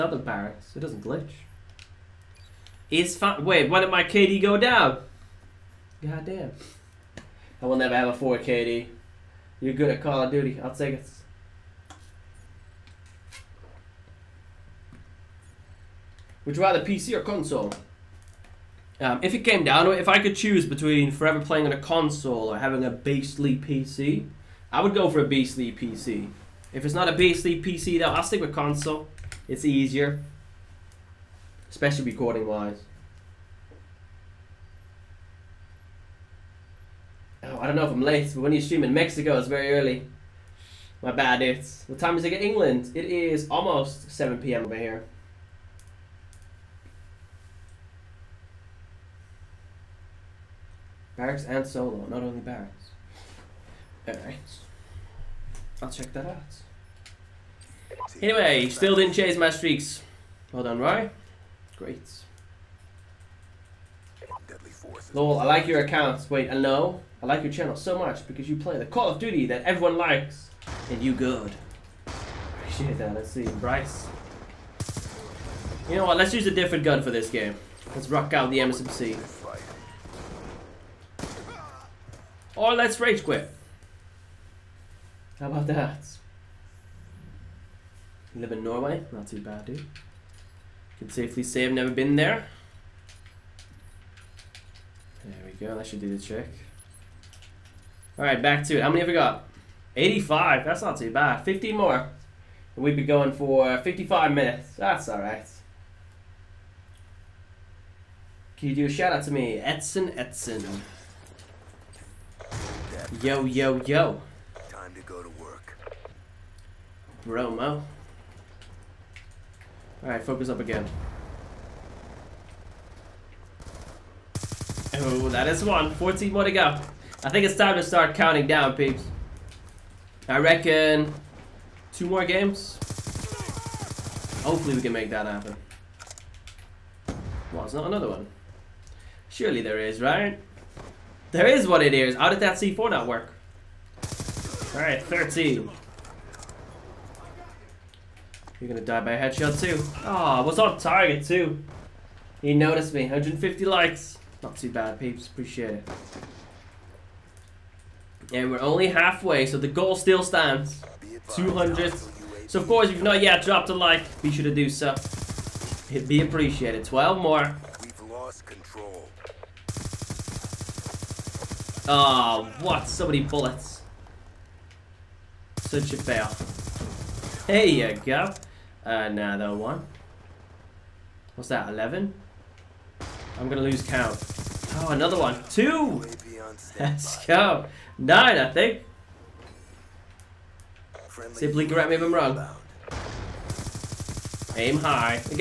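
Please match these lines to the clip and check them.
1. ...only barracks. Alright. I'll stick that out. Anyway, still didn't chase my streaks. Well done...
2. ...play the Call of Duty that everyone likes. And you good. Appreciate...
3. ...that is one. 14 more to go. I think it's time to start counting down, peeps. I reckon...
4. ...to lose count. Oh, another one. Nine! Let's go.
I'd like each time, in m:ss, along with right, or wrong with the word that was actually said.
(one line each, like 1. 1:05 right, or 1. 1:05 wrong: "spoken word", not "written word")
1. 0:52 wrong: "check", not "stick"
2. 1:08 right
3. 2:05 right
4. 3:03 wrong: "Two", not "Nine".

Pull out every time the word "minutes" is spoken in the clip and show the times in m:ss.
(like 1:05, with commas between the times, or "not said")
1:44.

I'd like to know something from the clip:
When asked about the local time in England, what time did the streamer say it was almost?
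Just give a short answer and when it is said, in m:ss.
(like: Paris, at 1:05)
7 p.m., at 0:44.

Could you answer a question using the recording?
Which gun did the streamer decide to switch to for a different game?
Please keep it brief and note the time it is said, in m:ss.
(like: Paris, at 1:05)
MSMC, at 1:18.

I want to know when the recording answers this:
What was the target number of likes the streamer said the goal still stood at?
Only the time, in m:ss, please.
2:41.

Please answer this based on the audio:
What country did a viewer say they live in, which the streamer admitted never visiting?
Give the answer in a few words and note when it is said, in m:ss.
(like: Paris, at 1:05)
Norway, at 1:28.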